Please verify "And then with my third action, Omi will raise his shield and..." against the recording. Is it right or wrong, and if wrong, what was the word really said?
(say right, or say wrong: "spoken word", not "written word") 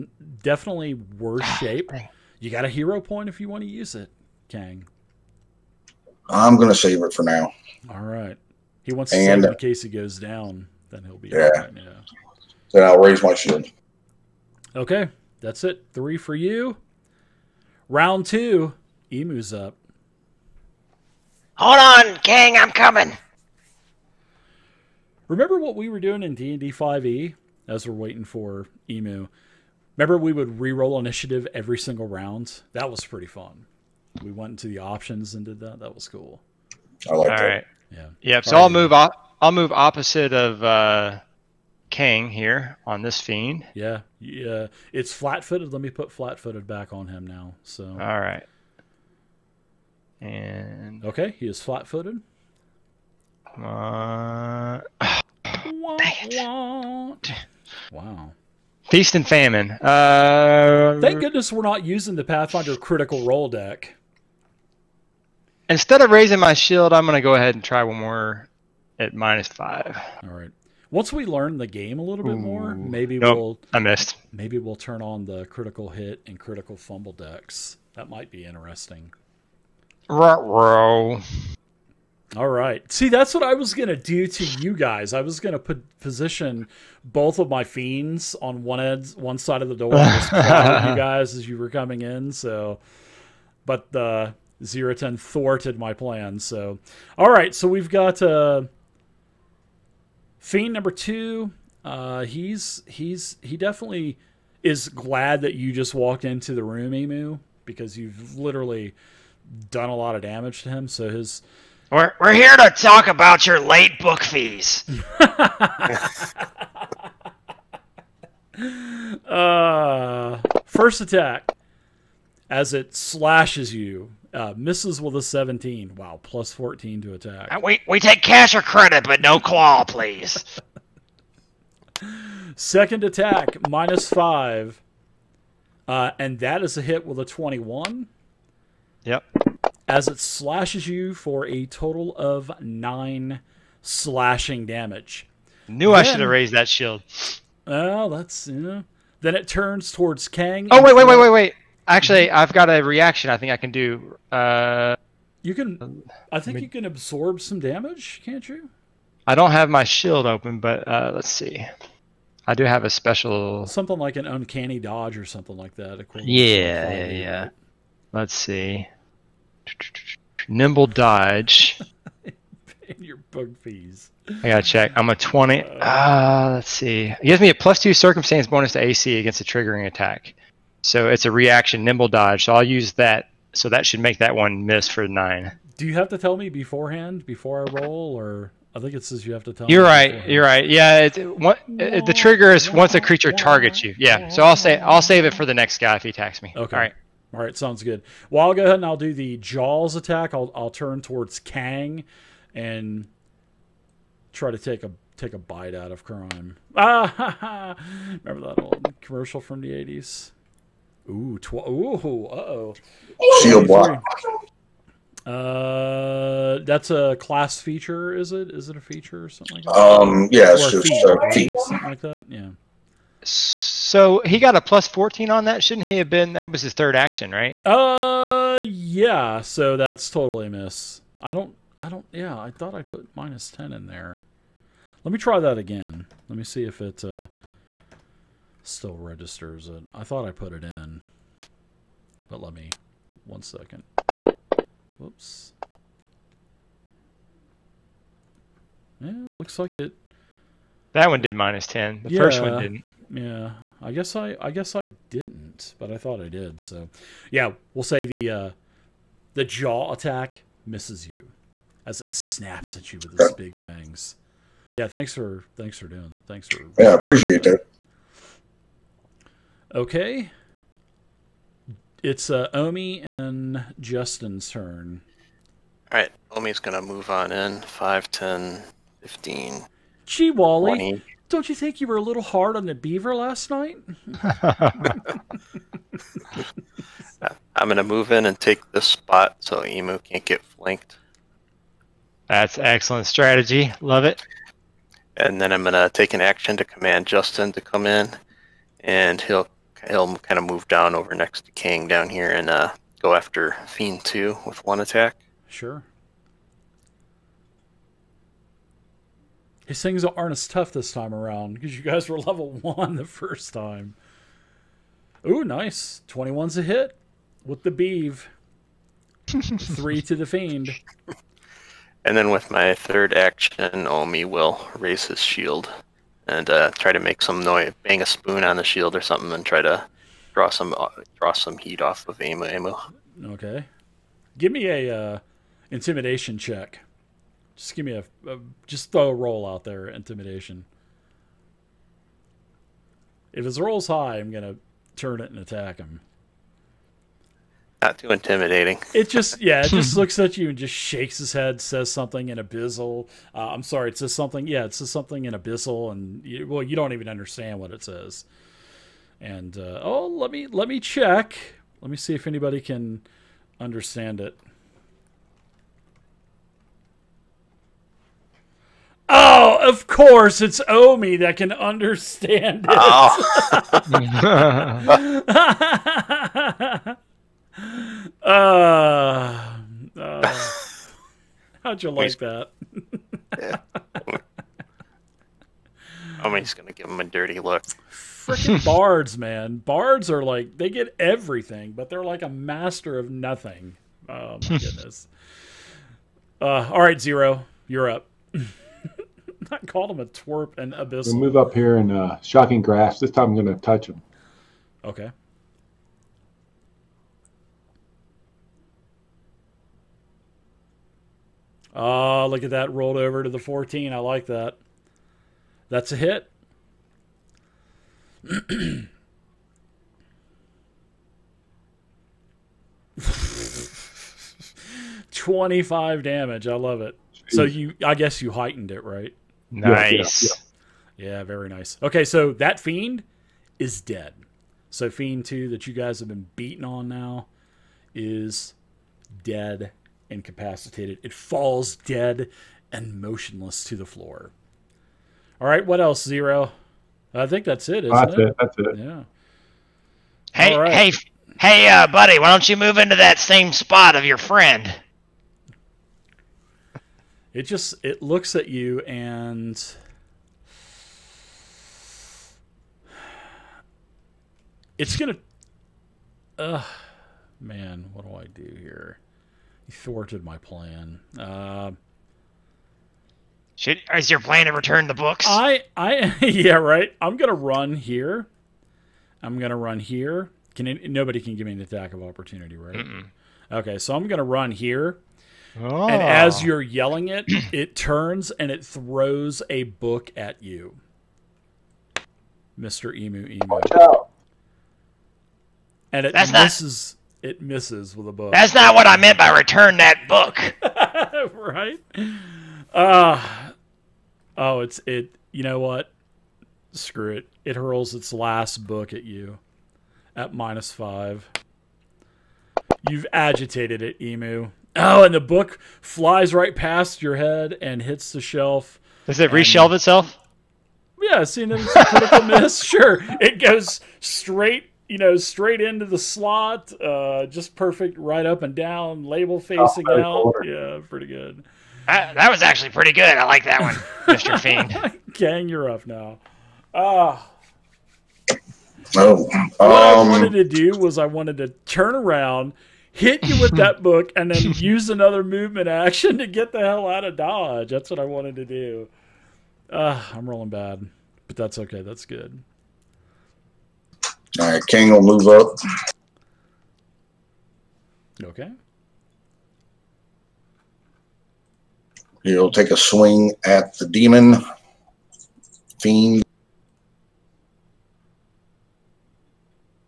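right.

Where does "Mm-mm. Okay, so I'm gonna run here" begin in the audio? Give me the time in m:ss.
8:02.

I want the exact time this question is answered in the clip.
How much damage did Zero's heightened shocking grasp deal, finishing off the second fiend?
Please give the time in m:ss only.
7:05.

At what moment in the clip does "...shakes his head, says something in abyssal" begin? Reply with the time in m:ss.
5:50.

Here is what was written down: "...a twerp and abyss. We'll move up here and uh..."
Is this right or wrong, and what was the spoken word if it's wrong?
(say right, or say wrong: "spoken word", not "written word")
right.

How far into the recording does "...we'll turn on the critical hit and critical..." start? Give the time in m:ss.
1:14.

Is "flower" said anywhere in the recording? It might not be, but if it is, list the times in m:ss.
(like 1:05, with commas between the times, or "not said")
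not said.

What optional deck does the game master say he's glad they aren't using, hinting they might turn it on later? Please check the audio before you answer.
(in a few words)
Pathfinder critical roll deck.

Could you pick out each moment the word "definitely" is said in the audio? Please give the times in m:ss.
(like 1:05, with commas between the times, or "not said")
0:00, 1:43.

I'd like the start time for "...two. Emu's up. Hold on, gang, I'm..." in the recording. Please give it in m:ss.
0:18.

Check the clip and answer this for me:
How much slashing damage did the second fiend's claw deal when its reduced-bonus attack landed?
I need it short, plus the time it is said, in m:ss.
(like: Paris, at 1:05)
9, at 2:22.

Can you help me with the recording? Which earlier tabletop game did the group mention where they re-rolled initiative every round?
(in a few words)
D&D 5e.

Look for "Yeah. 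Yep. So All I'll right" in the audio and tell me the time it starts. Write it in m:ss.
0:37.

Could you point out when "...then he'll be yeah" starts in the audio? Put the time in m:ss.
0:10.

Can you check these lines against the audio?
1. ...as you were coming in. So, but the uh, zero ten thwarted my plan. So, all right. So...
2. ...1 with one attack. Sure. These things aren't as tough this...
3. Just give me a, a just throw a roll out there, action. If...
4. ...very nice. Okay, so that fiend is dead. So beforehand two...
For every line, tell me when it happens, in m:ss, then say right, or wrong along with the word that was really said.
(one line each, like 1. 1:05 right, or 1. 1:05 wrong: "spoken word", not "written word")
1. 1:31 right
2. 5:04 wrong: "2", not "1"
3. 5:37 wrong: "intimidation", not "action"
4. 7:11 wrong: "fiend", not "beforehand".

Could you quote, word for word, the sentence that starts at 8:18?
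That's not what I meant by return that book.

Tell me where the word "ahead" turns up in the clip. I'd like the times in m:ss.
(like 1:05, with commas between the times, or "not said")
1:07, 3:18.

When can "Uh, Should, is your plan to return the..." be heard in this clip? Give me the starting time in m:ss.
7:51.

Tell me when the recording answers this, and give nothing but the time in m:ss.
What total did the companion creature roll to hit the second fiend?
5:16.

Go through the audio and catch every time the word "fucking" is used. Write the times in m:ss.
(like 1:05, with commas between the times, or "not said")
not said.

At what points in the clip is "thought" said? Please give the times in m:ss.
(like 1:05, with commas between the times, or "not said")
3:52, 4:00, 4:15.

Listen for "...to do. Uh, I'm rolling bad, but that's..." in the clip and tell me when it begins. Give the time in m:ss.
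9:08.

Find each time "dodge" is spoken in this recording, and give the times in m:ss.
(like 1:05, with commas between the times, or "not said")
2:44, 2:50, 3:02, 9:07.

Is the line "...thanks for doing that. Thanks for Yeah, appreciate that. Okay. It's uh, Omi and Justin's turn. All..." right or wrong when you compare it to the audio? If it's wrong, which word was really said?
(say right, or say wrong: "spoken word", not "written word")
right.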